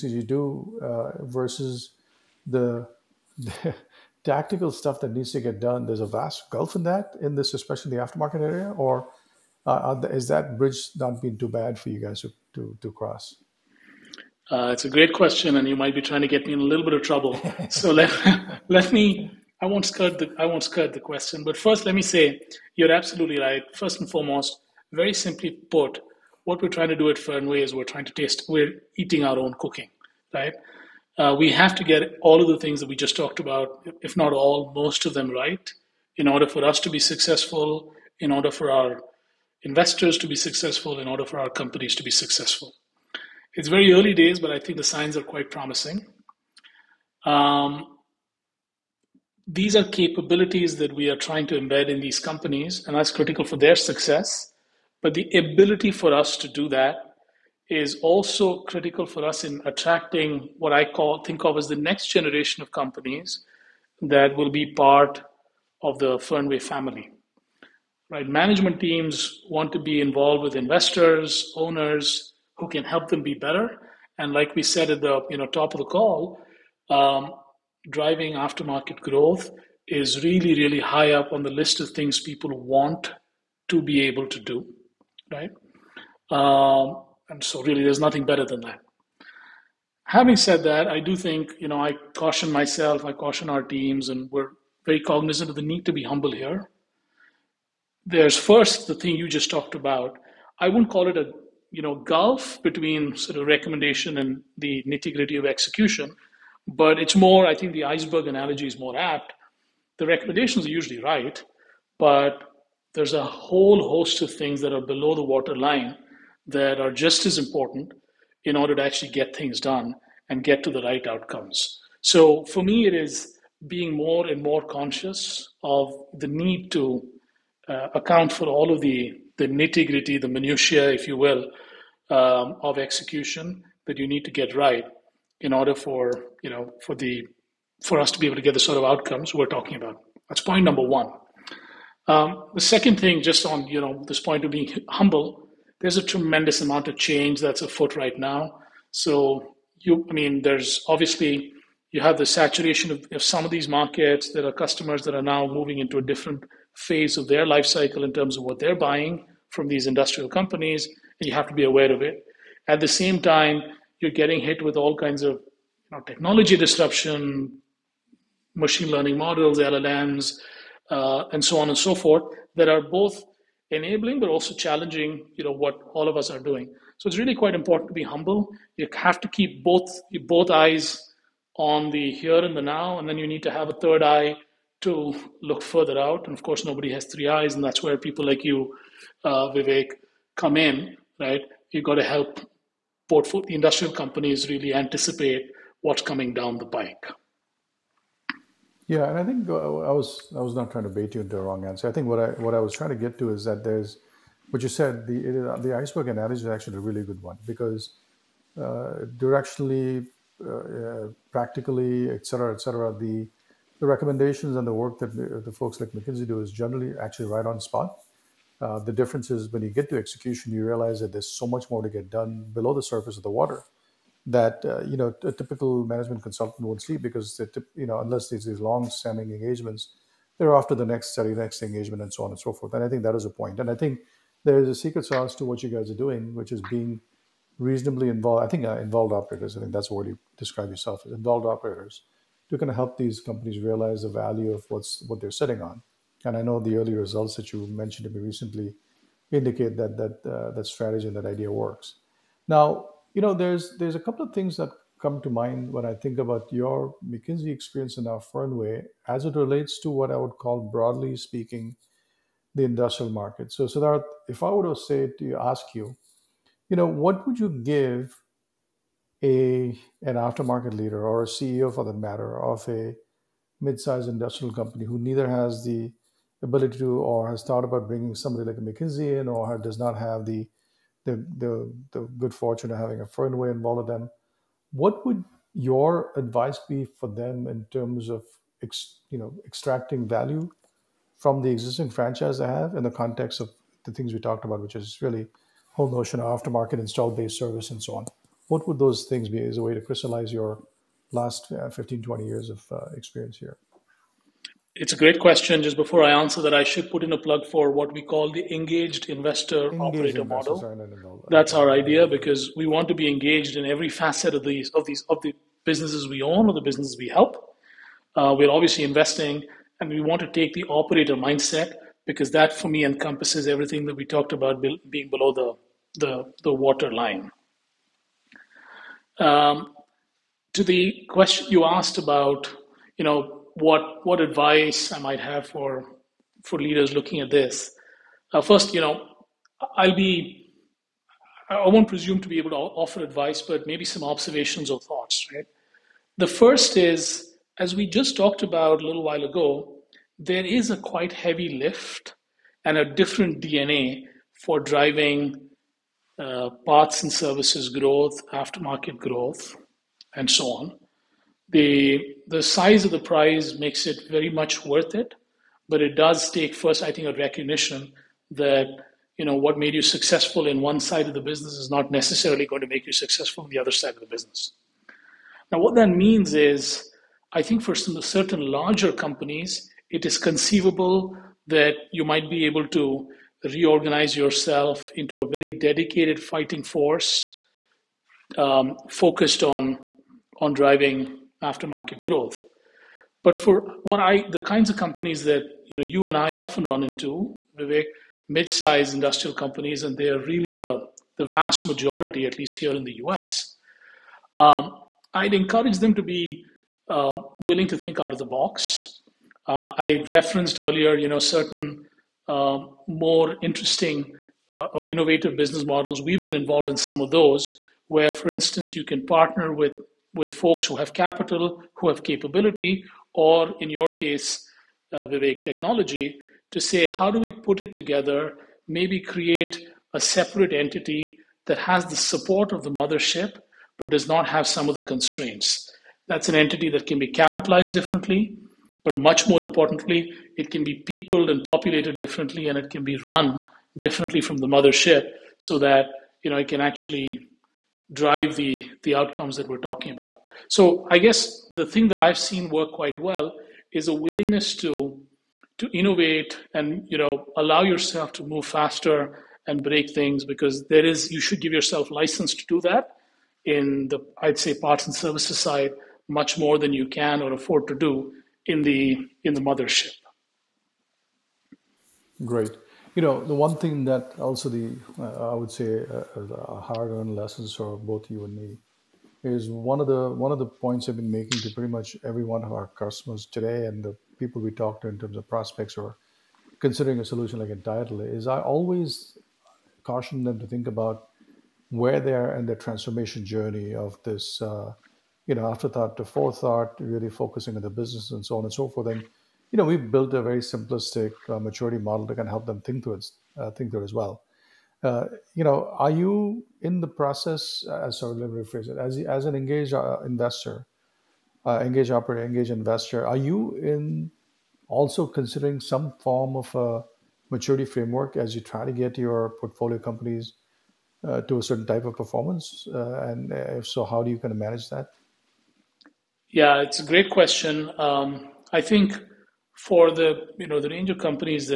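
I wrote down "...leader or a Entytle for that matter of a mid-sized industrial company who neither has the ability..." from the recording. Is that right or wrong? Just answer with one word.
wrong.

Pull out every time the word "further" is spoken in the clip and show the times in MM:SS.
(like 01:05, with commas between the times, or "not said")
03:05.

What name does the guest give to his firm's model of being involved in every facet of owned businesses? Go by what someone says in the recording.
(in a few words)
engaged investor engaged operator.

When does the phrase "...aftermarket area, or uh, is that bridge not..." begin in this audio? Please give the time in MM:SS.
00:08.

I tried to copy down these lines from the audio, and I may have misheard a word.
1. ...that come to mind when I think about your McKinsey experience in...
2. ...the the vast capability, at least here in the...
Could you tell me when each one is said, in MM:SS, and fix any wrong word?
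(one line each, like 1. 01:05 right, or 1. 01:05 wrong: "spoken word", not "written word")
1. 04:14 right
2. 06:40 wrong: "majority", not "capability".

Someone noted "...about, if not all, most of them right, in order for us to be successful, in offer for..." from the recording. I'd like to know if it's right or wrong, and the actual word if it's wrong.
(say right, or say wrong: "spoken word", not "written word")
wrong: "order", not "offer".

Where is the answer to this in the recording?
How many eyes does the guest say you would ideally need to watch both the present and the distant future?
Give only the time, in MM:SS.
03:07.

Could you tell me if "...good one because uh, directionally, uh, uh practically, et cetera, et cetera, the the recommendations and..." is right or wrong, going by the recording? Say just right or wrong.
right.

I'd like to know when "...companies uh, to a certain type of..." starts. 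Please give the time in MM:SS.
08:39.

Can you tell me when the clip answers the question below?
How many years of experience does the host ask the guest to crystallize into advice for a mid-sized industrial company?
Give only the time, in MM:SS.
05:01.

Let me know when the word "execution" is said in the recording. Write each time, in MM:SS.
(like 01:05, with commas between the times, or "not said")
01:45, 02:12, 03:39.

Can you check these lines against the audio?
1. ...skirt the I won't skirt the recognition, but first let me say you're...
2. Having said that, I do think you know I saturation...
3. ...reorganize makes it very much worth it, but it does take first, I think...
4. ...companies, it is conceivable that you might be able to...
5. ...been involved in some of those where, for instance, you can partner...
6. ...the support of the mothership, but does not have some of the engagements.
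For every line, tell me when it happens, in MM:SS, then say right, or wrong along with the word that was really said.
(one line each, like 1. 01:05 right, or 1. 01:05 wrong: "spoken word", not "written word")
1. 00:19 wrong: "question", not "recognition"
2. 01:30 wrong: "caution", not "saturation"
3. 06:02 wrong: "prize", not "reorganize"
4. 06:18 right
5. 06:56 right
6. 07:11 wrong: "constraints", not "engagements".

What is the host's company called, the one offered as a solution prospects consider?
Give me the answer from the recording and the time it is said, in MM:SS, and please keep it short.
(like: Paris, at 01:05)
Entytle, at 08:07.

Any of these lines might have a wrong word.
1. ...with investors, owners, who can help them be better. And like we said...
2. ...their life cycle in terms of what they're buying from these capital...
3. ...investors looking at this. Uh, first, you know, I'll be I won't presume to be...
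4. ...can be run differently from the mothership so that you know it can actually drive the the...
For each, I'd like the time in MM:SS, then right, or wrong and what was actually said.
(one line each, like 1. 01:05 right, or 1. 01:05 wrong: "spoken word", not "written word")
1. 01:10 right
2. 02:37 wrong: "industrial", not "capital"
3. 05:36 wrong: "leaders", not "investors"
4. 07:22 right.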